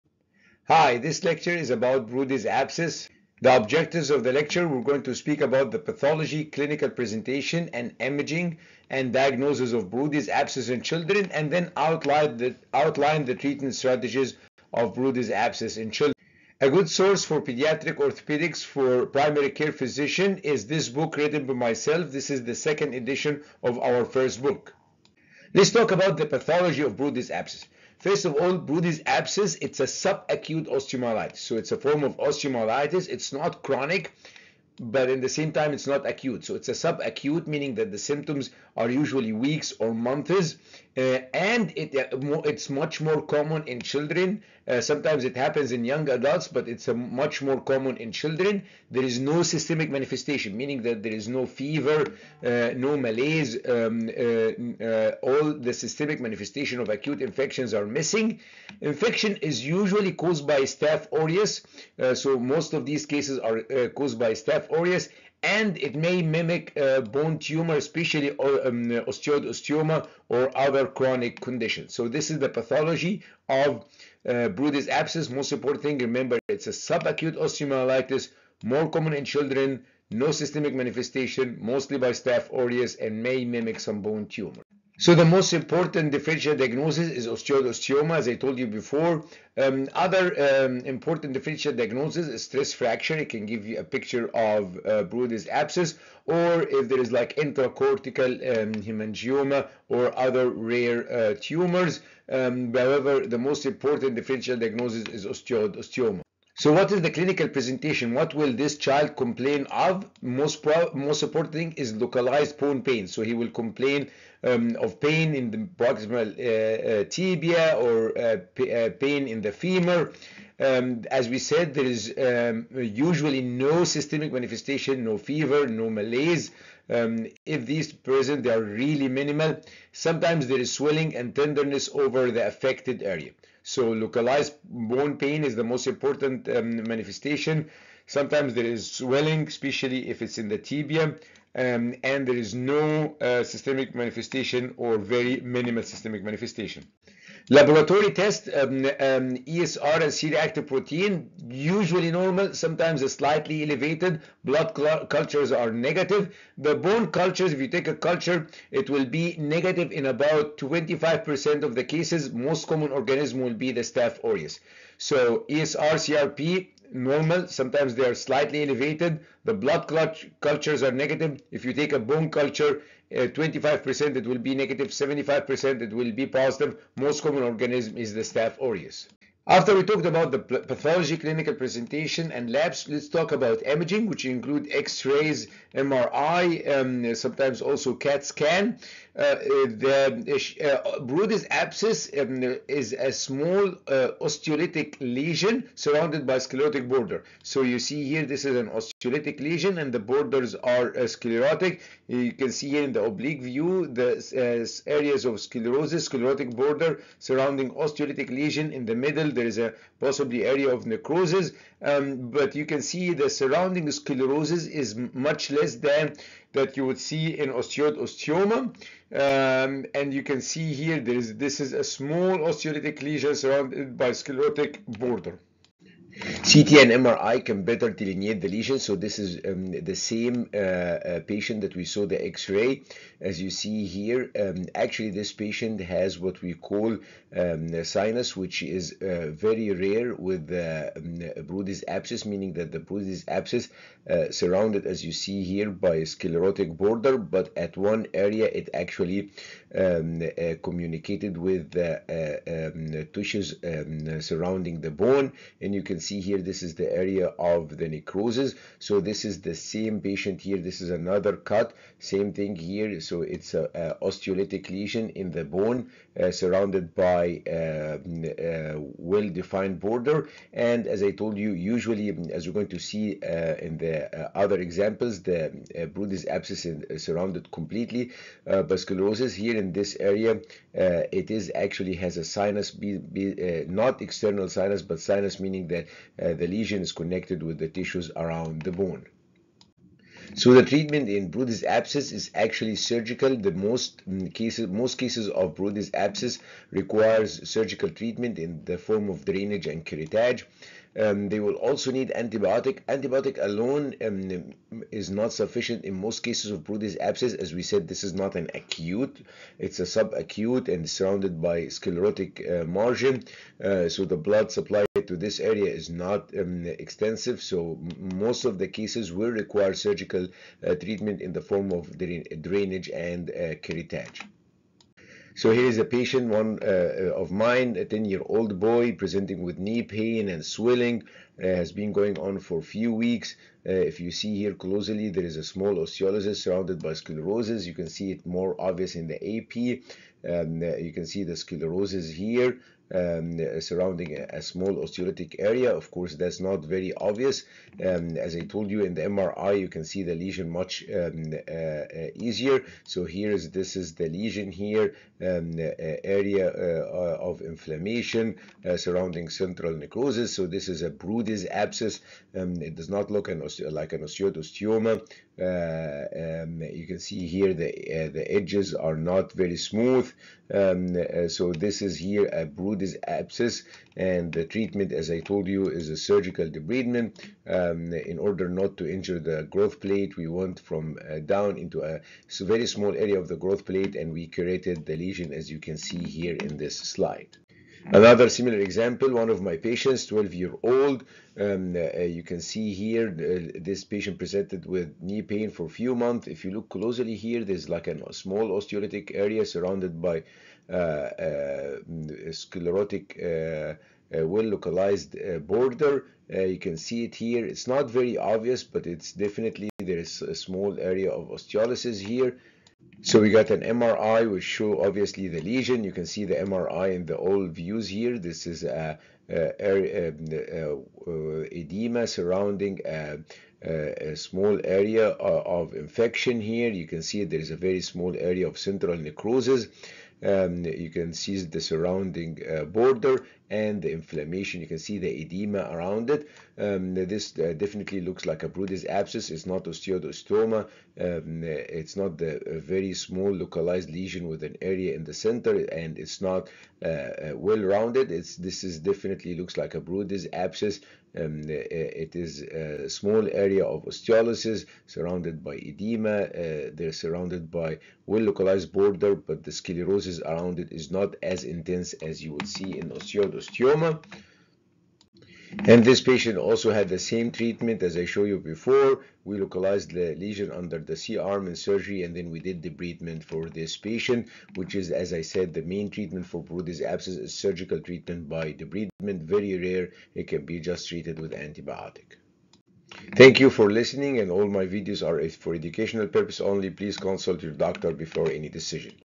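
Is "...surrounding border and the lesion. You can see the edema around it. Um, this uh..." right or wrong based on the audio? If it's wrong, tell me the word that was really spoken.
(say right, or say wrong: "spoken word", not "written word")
wrong: "inflammation", not "lesion".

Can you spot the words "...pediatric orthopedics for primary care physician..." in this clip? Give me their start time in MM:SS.
00:17.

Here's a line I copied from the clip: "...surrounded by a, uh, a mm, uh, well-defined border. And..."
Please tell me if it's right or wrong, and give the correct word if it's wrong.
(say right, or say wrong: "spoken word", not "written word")
right.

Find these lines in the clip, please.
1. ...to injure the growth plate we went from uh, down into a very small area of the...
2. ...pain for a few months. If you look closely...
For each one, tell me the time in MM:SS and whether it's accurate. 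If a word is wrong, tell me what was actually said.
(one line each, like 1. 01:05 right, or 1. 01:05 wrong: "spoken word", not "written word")
1. 06:18 right
2. 06:35 right.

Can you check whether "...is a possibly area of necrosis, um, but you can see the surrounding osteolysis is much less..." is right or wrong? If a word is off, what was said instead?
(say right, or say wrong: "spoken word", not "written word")
wrong: "sclerosis", not "osteolysis".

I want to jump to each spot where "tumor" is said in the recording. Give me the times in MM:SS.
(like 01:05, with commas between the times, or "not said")
01:07, 01:24, 01:41.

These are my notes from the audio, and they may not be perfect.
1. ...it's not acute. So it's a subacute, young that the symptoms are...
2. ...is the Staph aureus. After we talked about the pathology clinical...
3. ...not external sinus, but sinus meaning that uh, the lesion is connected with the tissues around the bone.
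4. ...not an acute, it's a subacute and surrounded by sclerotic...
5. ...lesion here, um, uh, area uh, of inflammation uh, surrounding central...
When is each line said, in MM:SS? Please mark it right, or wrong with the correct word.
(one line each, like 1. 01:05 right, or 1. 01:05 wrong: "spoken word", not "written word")
1. 00:35 wrong: "meaning", not "young"
2. 02:57 right
3. 04:43 right
4. 05:08 right
5. 05:54 right.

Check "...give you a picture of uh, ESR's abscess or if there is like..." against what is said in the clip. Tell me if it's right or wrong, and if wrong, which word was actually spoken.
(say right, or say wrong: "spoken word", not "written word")
wrong: "Brodie", not "ESR".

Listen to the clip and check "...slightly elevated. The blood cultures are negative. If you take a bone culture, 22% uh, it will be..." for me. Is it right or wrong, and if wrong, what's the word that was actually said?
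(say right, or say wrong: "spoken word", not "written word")
wrong: "25", not "22".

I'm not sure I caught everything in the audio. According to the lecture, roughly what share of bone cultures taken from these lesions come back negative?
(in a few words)
25%.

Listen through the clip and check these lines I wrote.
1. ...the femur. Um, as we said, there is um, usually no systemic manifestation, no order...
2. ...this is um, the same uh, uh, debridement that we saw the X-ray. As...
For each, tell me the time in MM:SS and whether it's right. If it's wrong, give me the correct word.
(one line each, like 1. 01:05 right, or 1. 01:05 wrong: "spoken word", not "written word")
1. 01:59 wrong: "fever", not "order"
2. 03:48 wrong: "patient", not "debridement".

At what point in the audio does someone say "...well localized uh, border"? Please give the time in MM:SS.
06:44.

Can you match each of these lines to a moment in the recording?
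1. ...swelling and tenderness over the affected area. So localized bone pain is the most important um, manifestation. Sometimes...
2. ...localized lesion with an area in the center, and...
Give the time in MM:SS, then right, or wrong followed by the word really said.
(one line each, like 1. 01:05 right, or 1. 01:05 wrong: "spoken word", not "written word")
1. 02:10 right
2. 07:23 right.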